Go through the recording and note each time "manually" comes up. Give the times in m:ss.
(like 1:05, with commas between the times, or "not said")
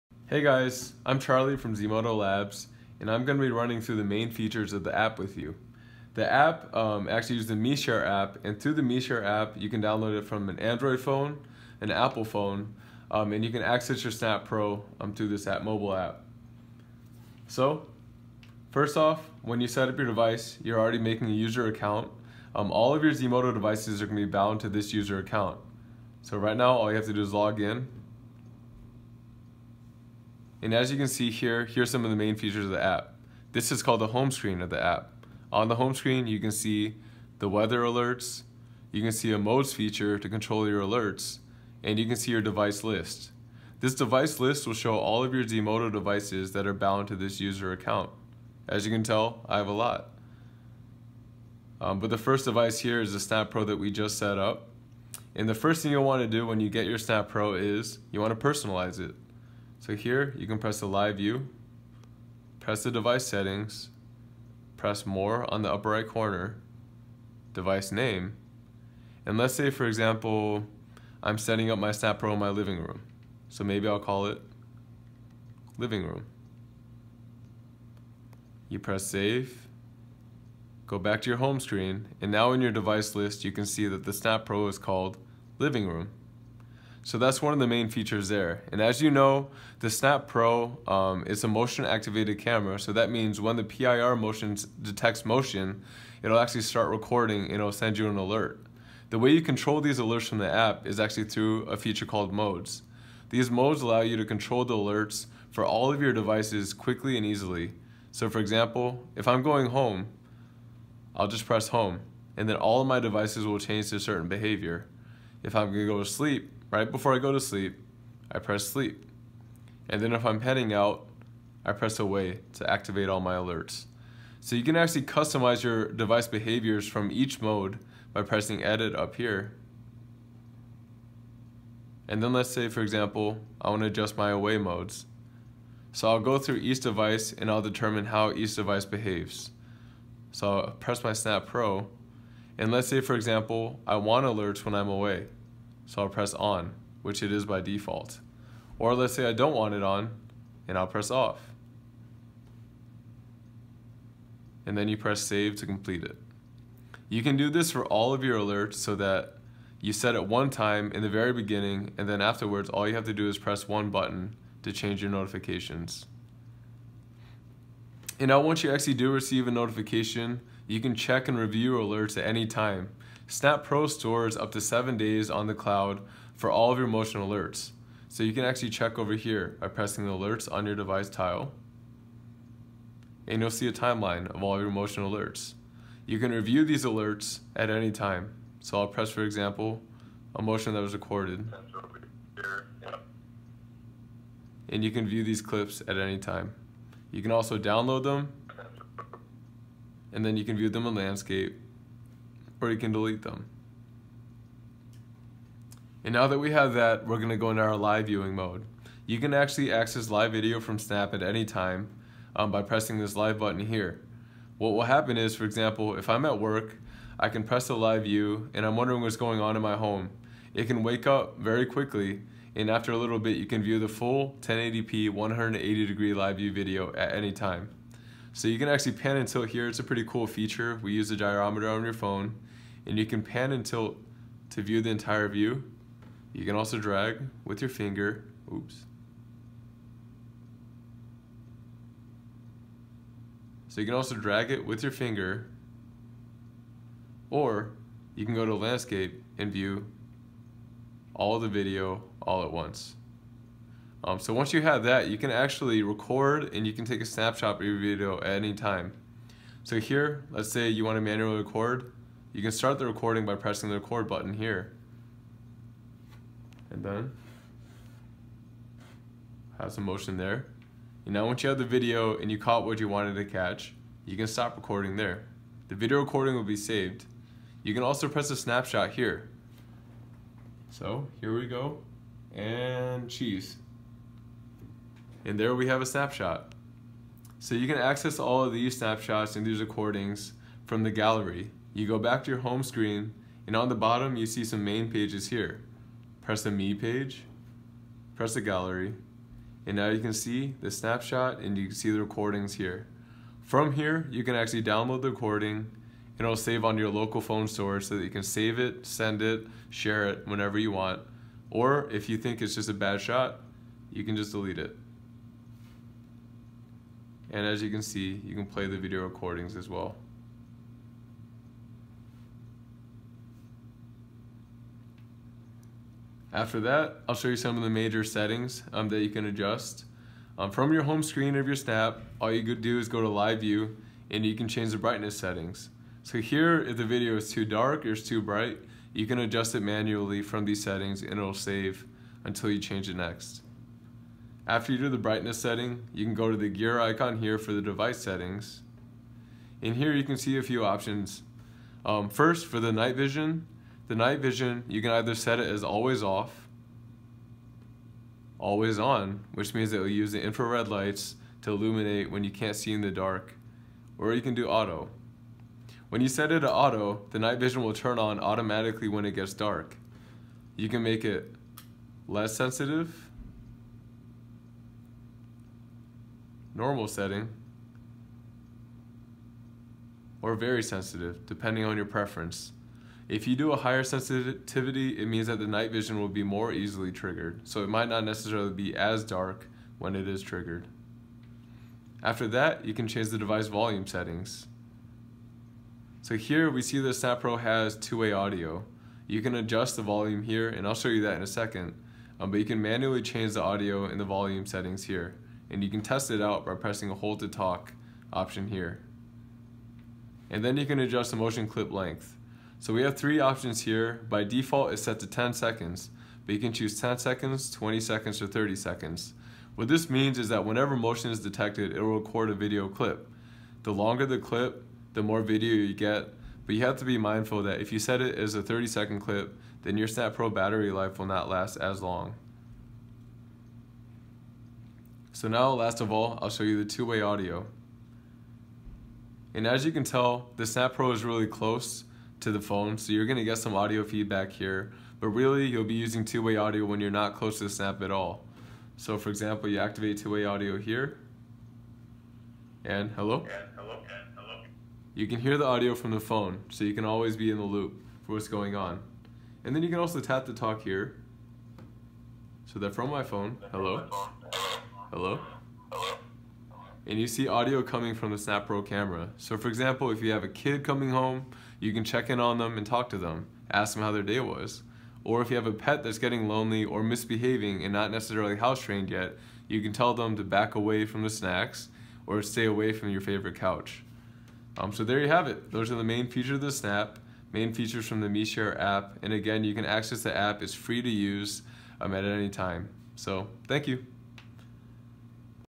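4:21, 5:39, 6:42.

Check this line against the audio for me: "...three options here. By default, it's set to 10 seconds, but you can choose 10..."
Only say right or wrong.
right.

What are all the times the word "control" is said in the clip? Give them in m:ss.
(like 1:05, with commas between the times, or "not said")
0:40, 1:39, 1:44.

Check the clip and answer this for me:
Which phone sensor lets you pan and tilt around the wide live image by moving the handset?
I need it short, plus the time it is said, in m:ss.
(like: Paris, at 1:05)
Gyrometer, at 3:51.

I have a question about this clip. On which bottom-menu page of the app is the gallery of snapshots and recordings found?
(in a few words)
Me page.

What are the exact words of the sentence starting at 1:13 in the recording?
So maybe I'll call it living room.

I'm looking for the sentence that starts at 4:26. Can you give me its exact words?
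And then have some motion there.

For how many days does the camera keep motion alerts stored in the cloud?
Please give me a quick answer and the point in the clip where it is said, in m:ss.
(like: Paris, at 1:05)
7, at 2:54.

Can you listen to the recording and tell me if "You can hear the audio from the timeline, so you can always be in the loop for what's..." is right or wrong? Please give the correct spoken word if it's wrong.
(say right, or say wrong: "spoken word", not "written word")
wrong: "phone", not "timeline".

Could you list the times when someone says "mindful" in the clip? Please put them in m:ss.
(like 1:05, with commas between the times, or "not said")
7:06.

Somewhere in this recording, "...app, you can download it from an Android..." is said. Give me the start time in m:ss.
0:09.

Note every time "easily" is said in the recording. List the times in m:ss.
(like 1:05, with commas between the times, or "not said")
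1:47, 6:26.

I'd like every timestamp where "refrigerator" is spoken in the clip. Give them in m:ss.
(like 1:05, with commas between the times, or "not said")
not said.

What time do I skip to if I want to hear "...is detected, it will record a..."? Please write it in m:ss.
7:01.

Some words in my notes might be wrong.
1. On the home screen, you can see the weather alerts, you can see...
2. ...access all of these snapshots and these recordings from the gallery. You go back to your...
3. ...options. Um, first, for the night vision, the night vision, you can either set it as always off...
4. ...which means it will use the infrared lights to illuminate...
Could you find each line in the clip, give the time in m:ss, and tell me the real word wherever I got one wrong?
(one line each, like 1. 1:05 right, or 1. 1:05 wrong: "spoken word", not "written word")
1. 0:35 right
2. 4:47 right
3. 5:50 right
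4. 5:59 right.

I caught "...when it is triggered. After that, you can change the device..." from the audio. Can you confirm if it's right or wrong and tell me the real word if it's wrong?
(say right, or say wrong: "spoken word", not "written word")
right.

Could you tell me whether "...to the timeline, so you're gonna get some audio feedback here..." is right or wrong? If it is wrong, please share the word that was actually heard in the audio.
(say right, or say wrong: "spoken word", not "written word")
wrong: "phone", not "timeline".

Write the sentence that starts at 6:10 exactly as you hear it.
You can make it less sensitive, normal setting, or very sensitive, depending on your preference.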